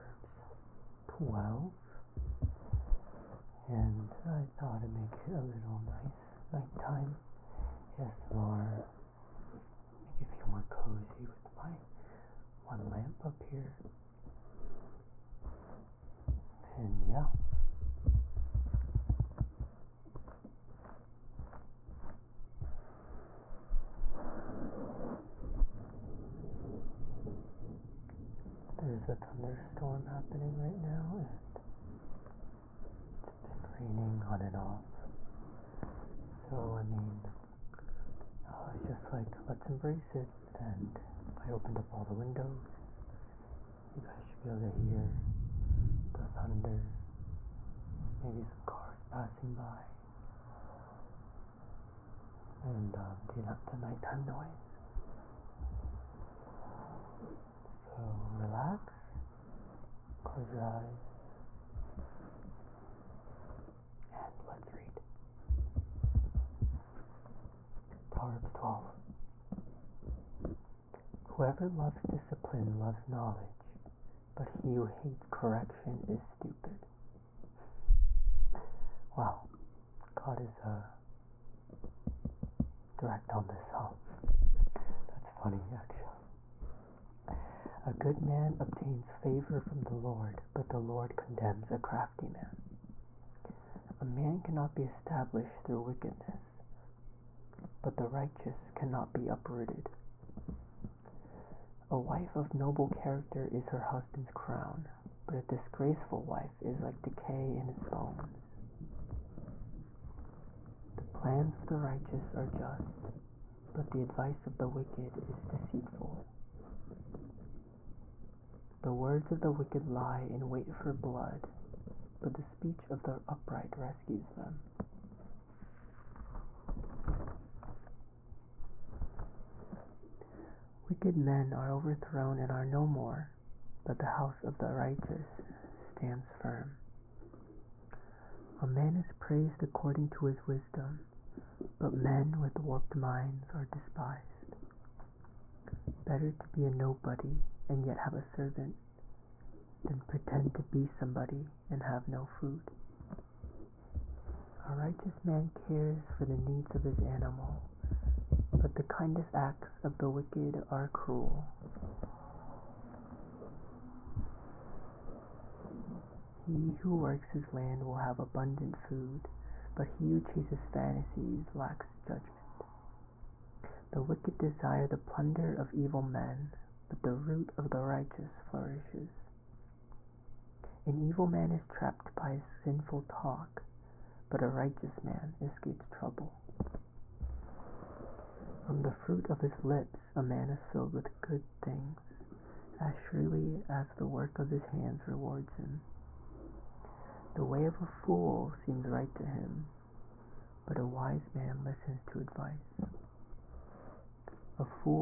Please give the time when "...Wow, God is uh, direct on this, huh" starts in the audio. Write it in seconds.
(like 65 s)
79 s.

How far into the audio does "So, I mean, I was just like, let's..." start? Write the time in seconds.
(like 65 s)
36 s.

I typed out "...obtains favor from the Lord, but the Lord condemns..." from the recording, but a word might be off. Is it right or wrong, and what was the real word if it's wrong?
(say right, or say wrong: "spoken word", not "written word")
right.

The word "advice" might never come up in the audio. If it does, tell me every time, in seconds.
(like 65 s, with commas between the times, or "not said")
114 s, 202 s.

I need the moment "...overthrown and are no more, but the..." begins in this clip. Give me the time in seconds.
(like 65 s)
131 s.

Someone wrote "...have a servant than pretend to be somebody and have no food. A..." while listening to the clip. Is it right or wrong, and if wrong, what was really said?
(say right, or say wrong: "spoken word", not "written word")
right.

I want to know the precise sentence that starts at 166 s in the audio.
He who works his land will have abundant food, but he who chases fantasies lacks judgment.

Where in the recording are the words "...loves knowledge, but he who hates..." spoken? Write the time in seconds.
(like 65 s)
72 s.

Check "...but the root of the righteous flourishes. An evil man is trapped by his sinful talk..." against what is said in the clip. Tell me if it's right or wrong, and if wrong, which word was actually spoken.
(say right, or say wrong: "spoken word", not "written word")
right.